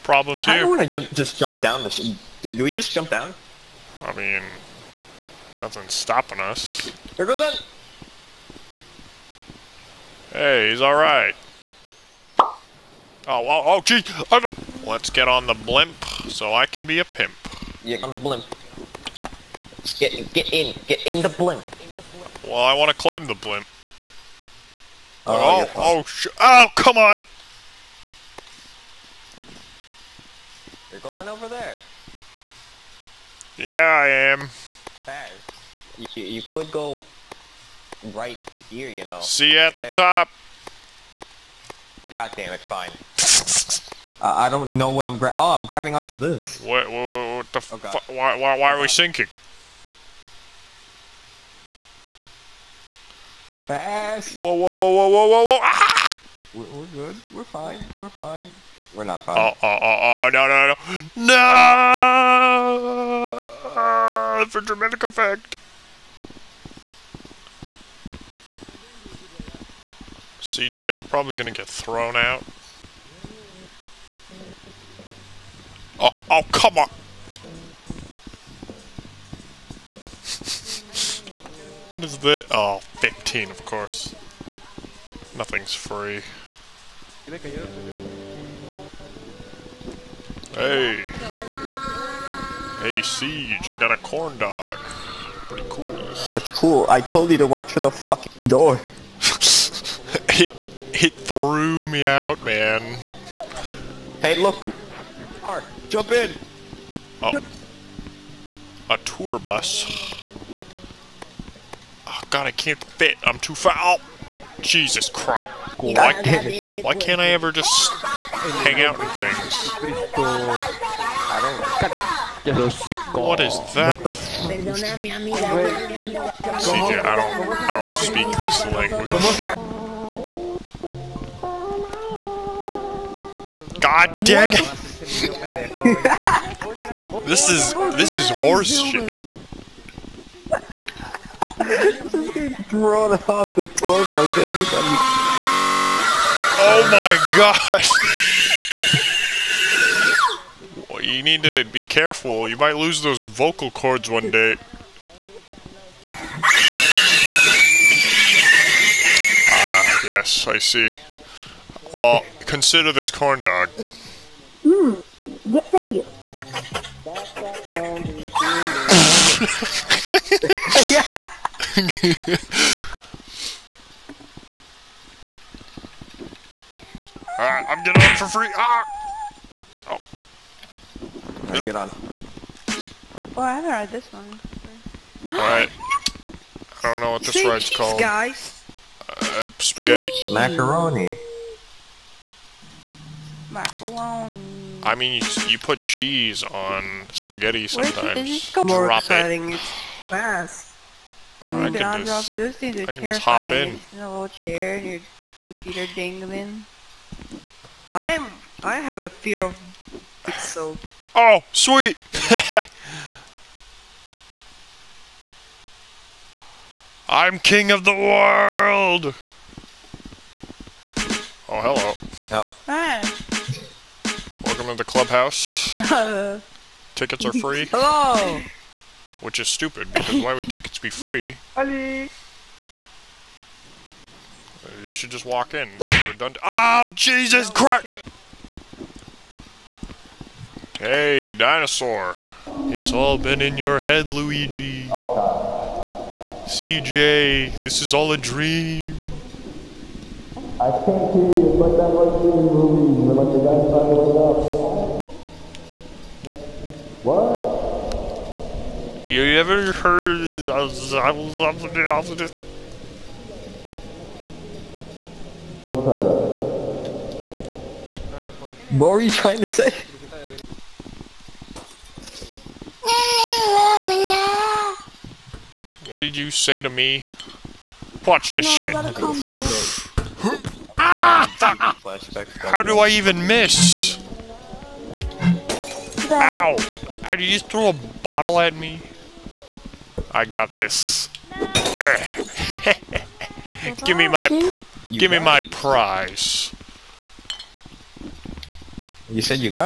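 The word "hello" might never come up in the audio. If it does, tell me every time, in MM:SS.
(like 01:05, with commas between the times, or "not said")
03:41, 03:47.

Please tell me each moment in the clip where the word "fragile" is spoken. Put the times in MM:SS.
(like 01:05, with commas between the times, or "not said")
not said.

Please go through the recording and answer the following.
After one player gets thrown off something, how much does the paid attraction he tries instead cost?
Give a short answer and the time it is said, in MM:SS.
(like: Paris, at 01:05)
15, at 01:22.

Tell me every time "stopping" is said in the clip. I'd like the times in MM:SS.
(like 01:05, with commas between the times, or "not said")
00:05.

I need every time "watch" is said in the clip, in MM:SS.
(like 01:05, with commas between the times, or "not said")
01:37, 04:38.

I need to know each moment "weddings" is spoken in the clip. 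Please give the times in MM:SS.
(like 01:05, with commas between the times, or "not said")
not said.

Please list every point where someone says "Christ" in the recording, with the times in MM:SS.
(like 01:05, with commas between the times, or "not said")
01:55, 03:57.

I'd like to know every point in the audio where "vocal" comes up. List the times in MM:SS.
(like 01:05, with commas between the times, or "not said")
02:33.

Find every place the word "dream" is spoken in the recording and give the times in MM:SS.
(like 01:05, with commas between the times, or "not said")
04:08, 04:12.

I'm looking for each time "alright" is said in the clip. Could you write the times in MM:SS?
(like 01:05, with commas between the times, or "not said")
00:10, 02:57, 03:05.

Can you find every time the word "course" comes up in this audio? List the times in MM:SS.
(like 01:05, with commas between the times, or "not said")
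01:23.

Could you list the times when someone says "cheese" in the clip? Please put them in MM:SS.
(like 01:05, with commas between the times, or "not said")
03:07, 03:15.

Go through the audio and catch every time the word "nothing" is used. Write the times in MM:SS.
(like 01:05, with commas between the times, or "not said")
00:05, 01:25.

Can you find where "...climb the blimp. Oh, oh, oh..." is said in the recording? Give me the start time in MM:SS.
00:22.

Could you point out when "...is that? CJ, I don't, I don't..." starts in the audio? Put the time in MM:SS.
02:03.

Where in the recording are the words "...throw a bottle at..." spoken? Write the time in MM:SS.
04:47.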